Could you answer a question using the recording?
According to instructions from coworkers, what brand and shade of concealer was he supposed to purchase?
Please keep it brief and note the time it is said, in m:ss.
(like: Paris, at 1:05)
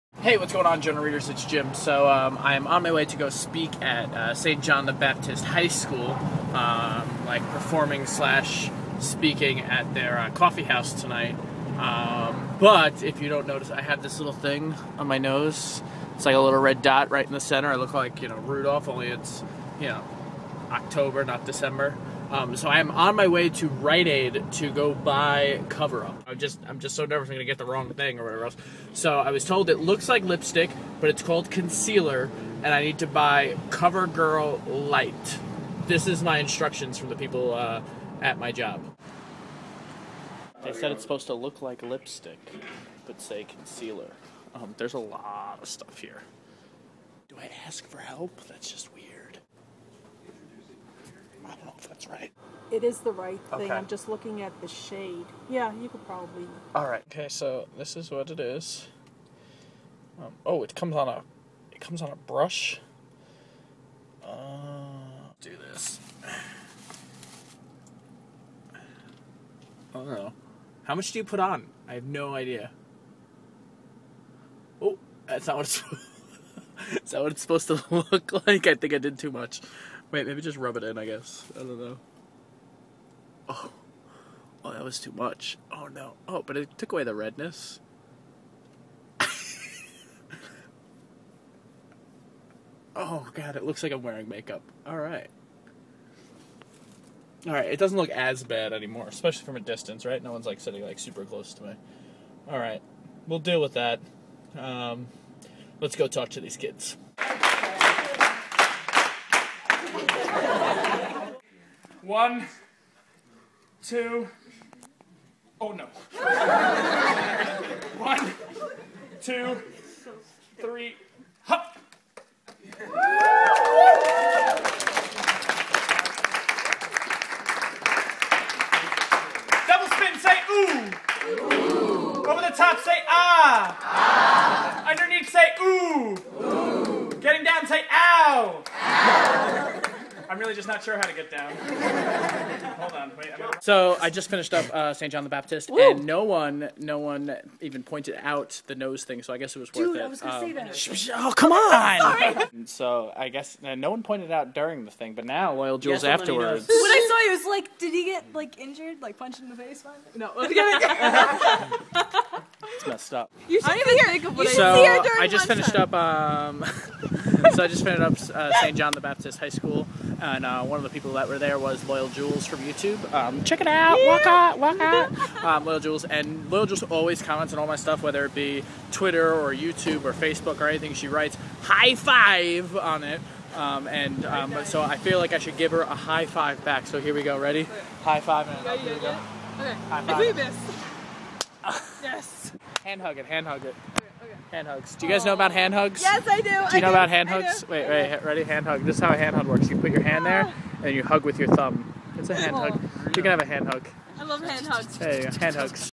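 Cover Girl Light, at 0:33.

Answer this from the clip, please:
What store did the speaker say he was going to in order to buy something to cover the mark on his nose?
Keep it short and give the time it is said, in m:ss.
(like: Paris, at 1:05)
Rite Aid, at 0:23.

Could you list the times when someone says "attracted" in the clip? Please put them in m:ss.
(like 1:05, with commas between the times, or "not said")
not said.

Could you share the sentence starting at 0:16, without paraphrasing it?
It's like a little red dot right in the center.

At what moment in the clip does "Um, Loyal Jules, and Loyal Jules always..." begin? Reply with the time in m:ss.
2:55.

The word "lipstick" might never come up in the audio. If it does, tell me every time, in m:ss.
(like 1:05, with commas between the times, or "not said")
0:30, 0:41.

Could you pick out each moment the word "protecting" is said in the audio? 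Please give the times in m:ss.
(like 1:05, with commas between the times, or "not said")
not said.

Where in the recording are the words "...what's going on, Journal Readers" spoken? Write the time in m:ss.
0:00.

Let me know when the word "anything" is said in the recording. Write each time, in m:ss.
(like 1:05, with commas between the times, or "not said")
3:00.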